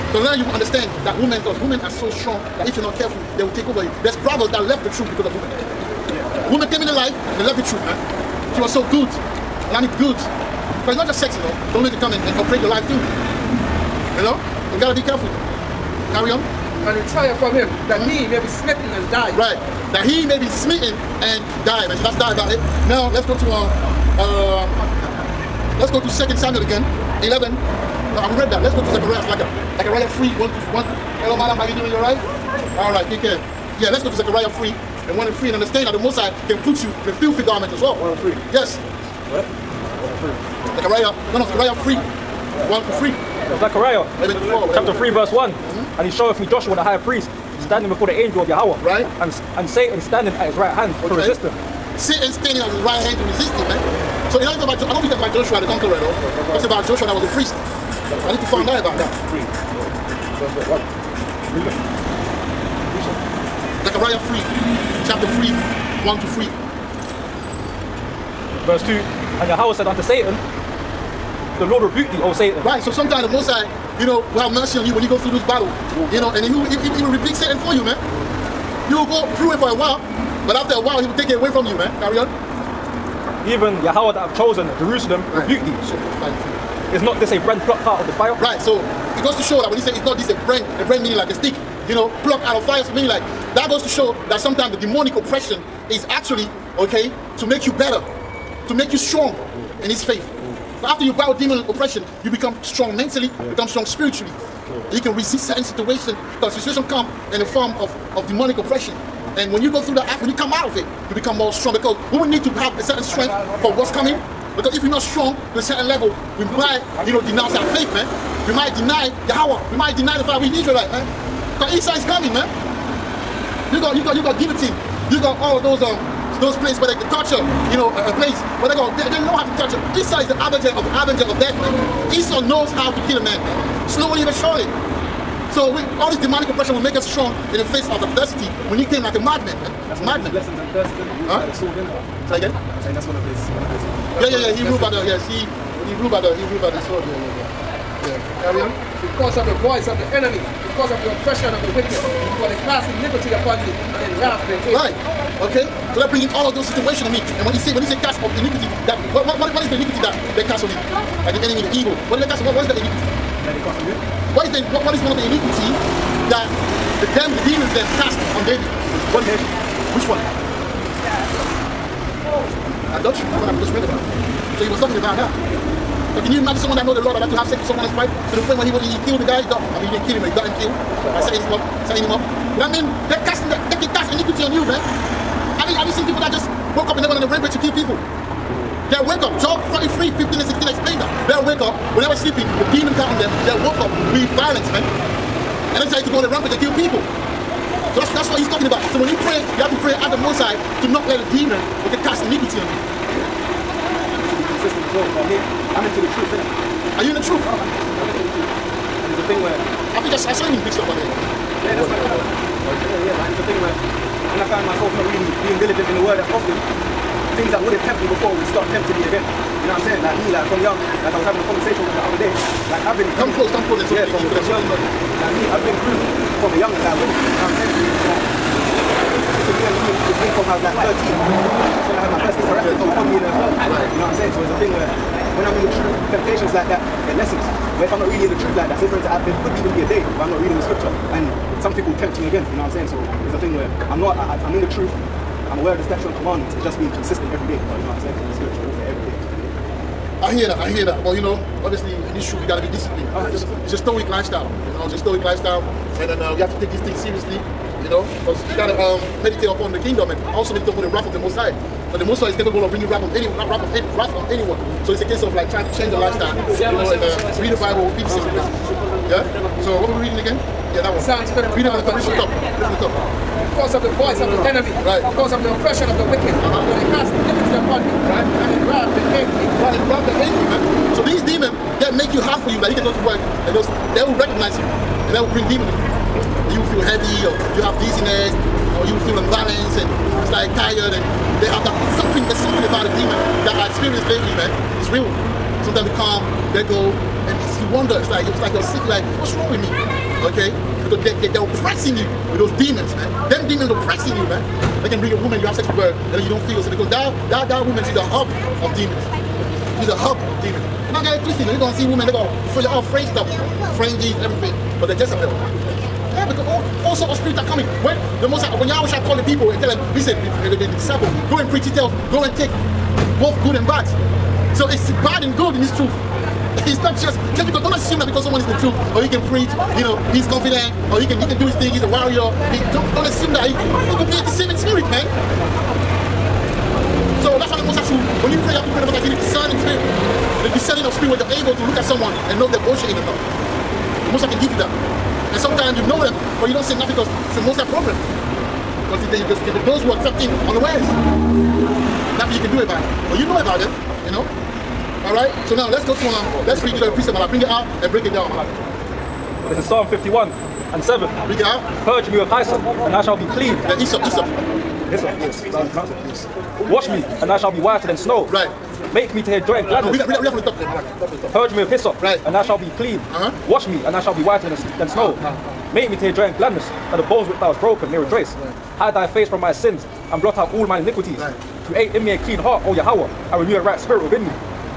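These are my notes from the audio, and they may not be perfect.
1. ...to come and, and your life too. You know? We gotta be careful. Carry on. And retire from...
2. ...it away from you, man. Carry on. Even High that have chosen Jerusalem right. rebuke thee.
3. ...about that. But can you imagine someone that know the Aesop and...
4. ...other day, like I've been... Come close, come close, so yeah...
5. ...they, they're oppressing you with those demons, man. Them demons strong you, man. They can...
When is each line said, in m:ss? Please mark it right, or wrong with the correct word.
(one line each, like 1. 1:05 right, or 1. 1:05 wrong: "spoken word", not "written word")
1. 0:11 right
2. 1:21 wrong: "Yahweh", not "High"
3. 2:54 wrong: "Lord", not "Aesop"
4. 3:42 right
5. 5:01 wrong: "oppressing", not "strong".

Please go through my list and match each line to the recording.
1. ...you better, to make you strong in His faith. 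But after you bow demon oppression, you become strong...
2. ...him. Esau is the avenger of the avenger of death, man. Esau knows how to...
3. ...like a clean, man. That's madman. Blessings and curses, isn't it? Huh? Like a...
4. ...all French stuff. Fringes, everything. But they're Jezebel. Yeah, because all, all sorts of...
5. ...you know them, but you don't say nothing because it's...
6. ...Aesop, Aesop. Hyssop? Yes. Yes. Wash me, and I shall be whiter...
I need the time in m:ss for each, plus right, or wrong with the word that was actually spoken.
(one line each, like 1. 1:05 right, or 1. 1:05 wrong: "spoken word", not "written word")
1. 1:37 right
2. 2:09 right
3. 2:19 wrong: "madman", not "clean"
4. 5:12 right
5. 5:45 right
6. 6:03 right.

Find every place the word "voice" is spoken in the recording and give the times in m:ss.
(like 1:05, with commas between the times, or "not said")
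2:29, 4:33.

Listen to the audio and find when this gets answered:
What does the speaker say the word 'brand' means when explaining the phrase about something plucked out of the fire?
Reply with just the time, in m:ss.
1:30.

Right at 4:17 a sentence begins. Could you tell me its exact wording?
You know, because you gotta um, meditate upon the kingdom and also meditate upon the wrath of the Most High.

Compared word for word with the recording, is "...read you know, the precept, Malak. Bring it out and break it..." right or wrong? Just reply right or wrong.
right.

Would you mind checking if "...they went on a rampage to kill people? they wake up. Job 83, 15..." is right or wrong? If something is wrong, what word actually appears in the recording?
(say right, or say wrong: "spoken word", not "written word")
wrong: "43", not "83".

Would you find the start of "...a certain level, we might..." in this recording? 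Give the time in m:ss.
1:55.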